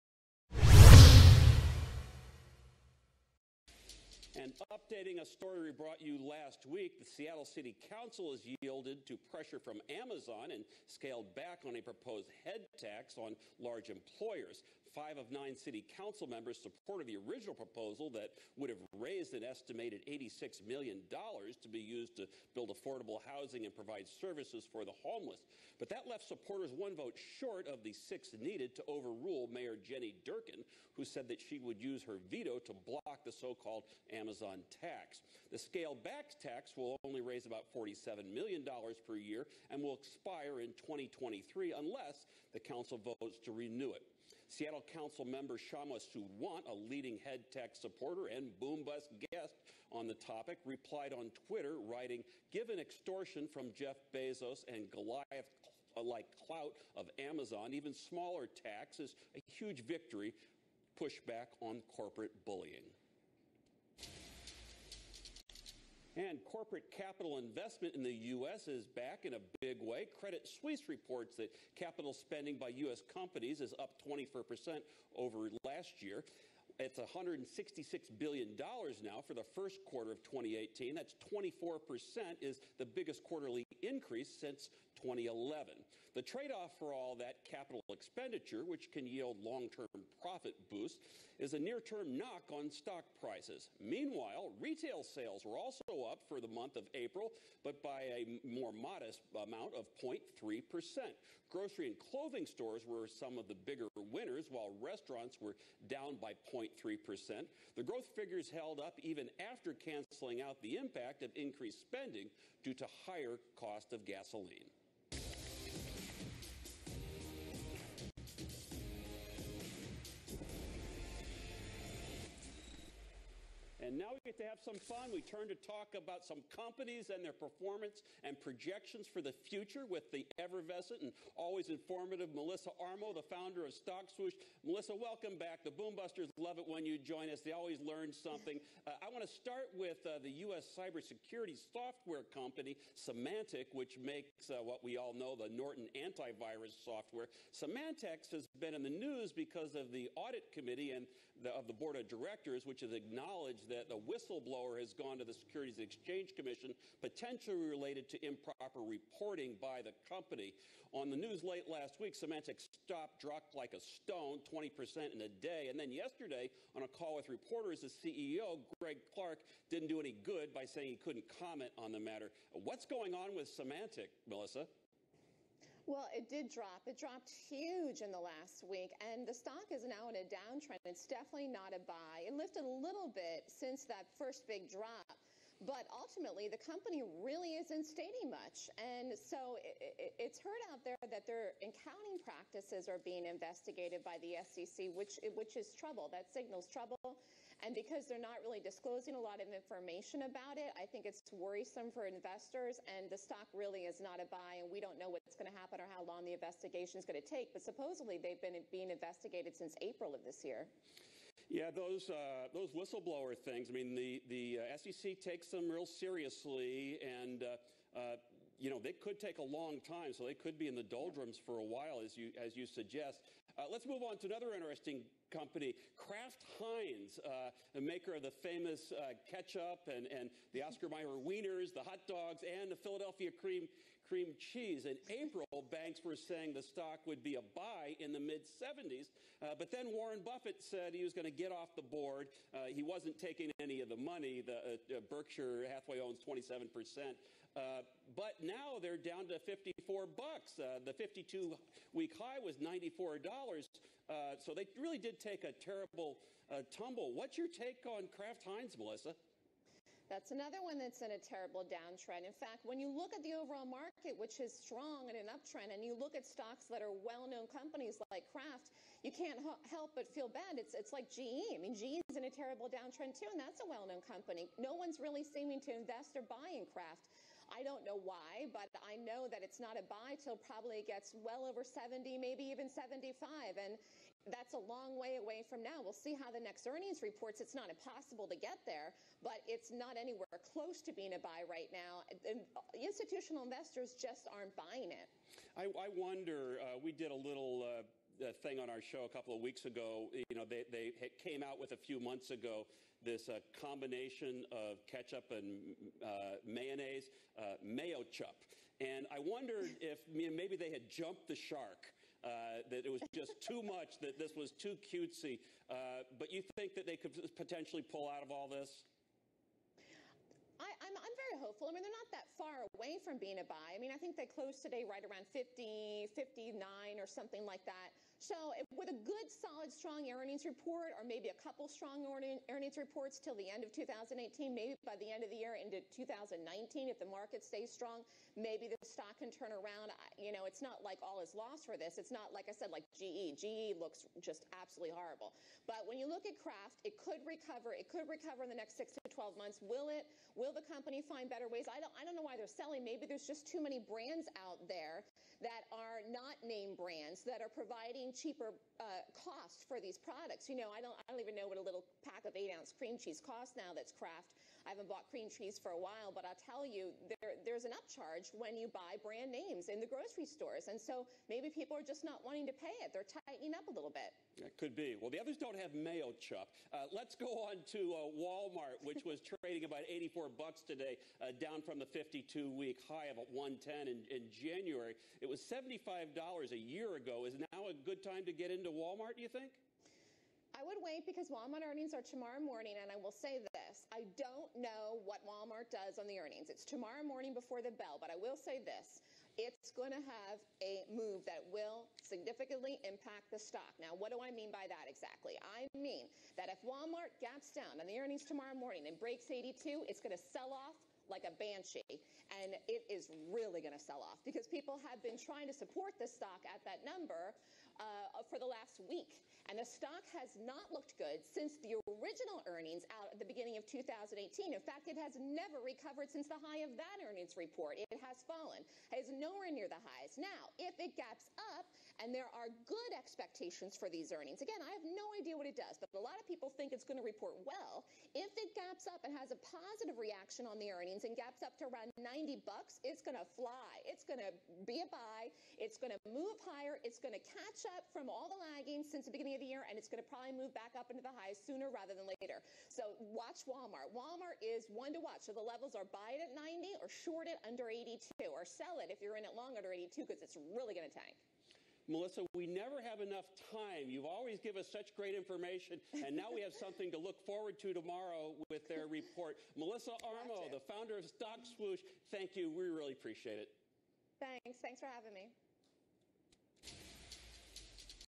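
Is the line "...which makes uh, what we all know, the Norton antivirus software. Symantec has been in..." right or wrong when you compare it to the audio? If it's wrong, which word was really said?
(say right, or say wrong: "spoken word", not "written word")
right.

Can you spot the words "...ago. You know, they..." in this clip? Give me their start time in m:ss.
4:59.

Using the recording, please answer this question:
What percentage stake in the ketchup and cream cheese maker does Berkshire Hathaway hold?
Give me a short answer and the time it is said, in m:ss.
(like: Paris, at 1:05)
27%, at 4:06.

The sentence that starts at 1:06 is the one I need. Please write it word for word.
And corporate capital investment in the U.S.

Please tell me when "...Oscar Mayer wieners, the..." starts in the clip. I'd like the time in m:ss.
3:50.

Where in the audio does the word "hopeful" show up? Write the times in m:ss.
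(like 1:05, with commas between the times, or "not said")
5:21.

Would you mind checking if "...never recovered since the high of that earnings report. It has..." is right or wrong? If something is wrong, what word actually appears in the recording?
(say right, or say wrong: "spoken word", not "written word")
right.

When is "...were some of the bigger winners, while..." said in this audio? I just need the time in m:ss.
1:42.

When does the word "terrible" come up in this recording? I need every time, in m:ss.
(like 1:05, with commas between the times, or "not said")
4:15, 4:21, 4:32.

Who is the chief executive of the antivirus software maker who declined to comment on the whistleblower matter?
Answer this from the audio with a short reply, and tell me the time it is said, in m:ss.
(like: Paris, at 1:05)
Greg Clark, at 2:48.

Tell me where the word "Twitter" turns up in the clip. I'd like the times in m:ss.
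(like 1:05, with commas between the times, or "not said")
0:51.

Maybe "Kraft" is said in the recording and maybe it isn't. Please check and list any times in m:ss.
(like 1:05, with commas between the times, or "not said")
3:45, 4:18, 4:28, 4:36, 5:46, 6:03.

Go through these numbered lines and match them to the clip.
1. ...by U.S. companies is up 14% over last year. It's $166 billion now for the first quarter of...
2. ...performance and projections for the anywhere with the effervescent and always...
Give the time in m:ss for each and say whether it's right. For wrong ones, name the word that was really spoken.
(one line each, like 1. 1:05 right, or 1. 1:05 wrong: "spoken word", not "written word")
1. 1:12 wrong: "24", not "14"
2. 2:07 wrong: "future", not "anywhere".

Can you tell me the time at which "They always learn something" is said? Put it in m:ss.
2:17.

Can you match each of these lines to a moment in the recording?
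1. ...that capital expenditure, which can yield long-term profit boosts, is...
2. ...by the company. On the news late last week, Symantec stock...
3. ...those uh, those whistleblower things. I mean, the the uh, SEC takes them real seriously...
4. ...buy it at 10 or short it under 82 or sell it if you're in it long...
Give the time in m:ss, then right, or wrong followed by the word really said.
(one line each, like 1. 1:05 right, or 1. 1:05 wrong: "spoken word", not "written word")
1. 1:27 right
2. 2:39 right
3. 3:31 right
4. 7:35 wrong: "90", not "10".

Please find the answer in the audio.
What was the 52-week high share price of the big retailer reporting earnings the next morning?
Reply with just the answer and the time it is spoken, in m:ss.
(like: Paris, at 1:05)
110, at 6:23.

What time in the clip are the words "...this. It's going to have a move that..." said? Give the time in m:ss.
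6:38.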